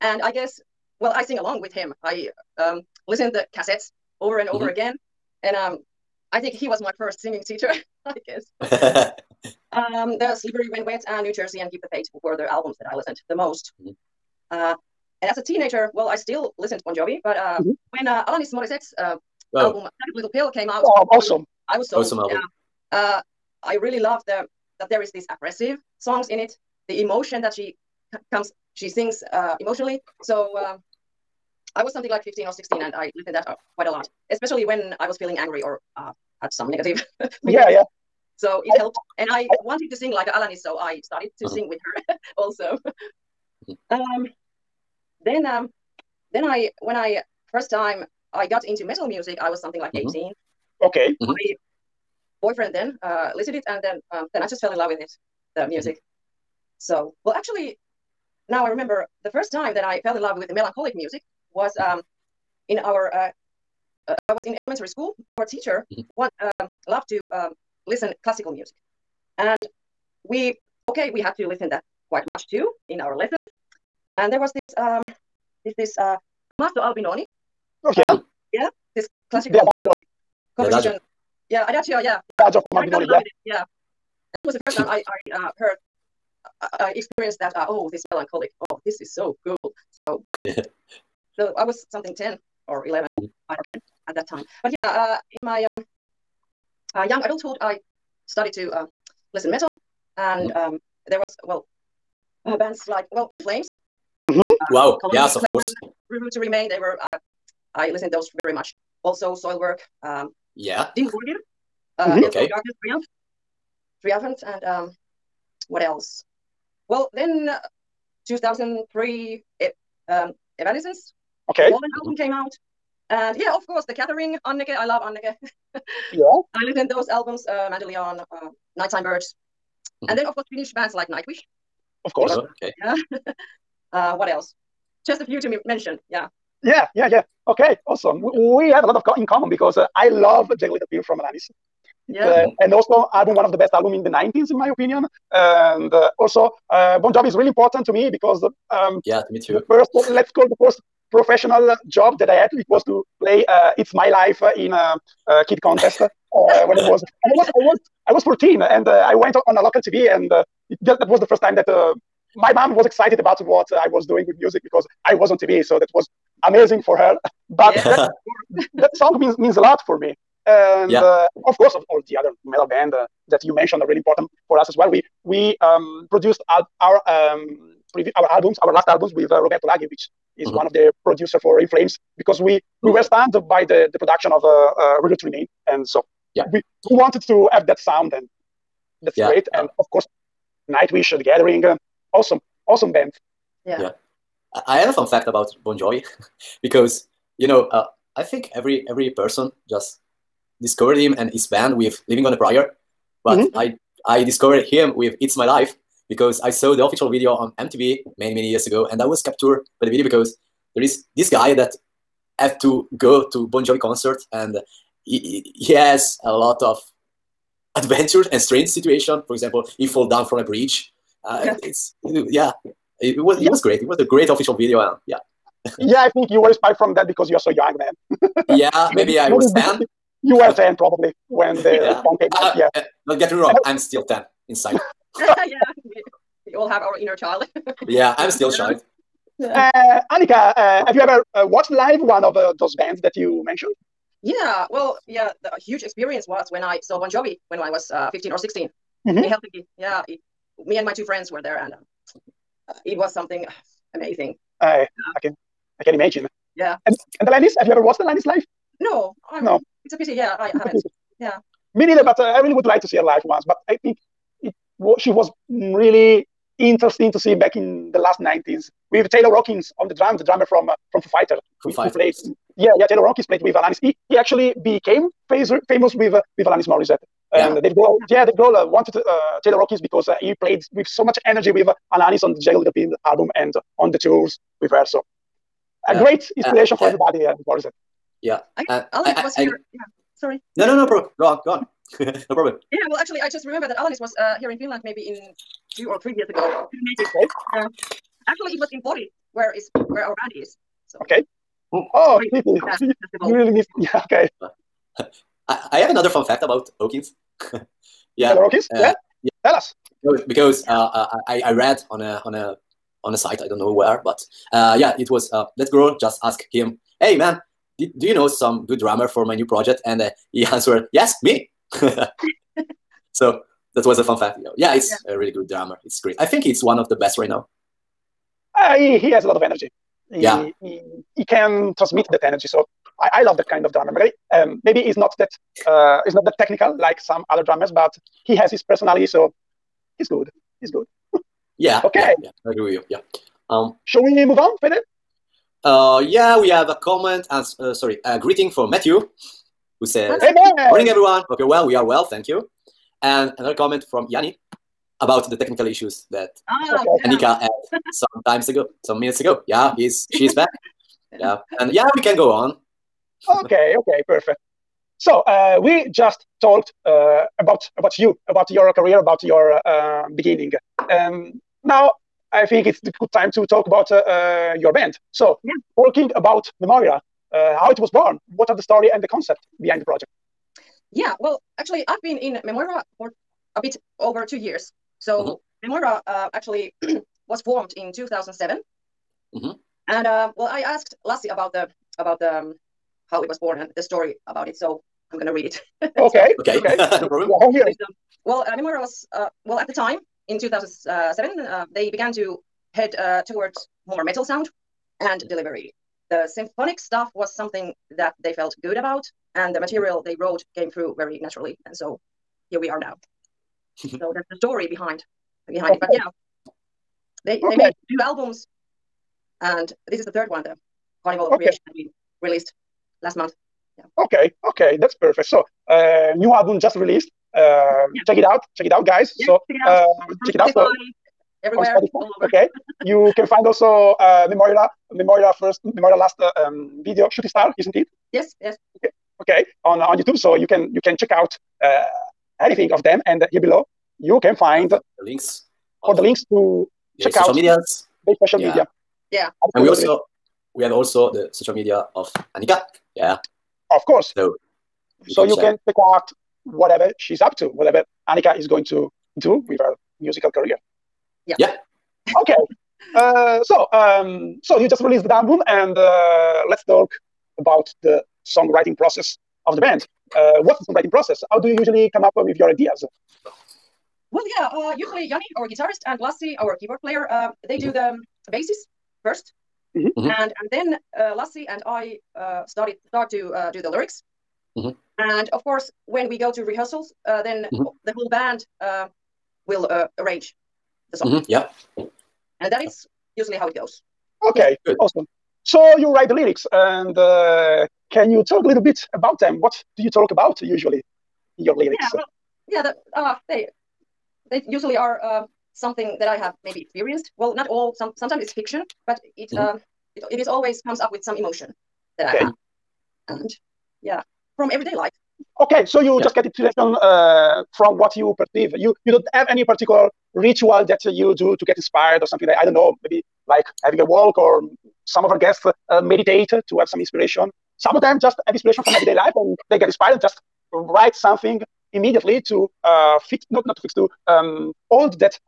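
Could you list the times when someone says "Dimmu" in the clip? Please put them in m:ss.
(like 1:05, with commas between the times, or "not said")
1:50.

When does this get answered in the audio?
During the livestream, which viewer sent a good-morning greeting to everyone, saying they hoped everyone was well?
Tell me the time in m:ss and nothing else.
5:48.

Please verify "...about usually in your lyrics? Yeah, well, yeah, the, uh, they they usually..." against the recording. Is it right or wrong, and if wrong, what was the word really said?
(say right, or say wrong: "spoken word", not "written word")
right.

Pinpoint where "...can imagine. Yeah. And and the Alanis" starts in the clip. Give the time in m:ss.
4:15.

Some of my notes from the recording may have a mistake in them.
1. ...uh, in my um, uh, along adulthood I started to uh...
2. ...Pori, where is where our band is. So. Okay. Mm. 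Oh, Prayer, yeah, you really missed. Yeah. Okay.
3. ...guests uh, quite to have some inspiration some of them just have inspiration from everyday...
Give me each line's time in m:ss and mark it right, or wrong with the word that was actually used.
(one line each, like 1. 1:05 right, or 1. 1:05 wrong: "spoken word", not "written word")
1. 1:34 wrong: "young", not "along"
2. 4:58 wrong: "Pori", not "Prayer"
3. 8:45 wrong: "meditate", not "quite".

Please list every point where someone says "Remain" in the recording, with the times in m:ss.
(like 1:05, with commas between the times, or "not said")
1:46, 3:05.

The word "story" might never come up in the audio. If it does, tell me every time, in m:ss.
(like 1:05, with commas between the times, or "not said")
6:18, 6:33, 6:54.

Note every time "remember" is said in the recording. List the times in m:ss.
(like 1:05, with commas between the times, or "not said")
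0:58, 4:53.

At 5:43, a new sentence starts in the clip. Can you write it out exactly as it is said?
Um, Shall we move on, Fede?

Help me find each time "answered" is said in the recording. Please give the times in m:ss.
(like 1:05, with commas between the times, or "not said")
5:20.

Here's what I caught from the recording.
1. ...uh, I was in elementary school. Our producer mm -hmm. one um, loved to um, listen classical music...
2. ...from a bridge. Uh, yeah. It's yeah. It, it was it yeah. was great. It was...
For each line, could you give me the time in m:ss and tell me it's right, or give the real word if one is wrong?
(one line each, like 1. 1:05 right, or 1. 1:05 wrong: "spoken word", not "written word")
1. 1:04 wrong: "teacher", not "producer"
2. 3:40 right.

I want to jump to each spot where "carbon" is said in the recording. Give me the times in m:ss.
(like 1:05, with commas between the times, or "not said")
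not said.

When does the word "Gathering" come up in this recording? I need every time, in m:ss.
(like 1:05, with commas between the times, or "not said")
2:03, 3:11.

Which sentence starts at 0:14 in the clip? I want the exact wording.
uh, and as a teenager well i still listened bon jovi but uh, mm-hmm when uh, Alanis Morissette's uh, oh.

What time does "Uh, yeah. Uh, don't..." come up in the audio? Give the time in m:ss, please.
3:52.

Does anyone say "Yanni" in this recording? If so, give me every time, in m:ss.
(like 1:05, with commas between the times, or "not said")
5:54, 7:55.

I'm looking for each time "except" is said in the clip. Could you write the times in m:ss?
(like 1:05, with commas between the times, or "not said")
not said.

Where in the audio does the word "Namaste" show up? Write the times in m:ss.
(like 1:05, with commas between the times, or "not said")
not said.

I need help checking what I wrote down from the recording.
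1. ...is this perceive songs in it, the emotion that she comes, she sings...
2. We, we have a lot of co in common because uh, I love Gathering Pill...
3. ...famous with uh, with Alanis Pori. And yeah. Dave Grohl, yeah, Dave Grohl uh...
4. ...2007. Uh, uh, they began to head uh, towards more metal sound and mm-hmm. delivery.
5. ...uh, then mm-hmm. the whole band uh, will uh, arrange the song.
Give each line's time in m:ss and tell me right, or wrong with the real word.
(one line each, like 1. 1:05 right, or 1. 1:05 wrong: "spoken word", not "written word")
1. 0:25 wrong: "aggressive", not "perceive"
2. 2:18 wrong: "Jagged", not "Gathering"
3. 4:35 wrong: "Morissette", not "Pori"
4. 6:40 right
5. 8:07 right.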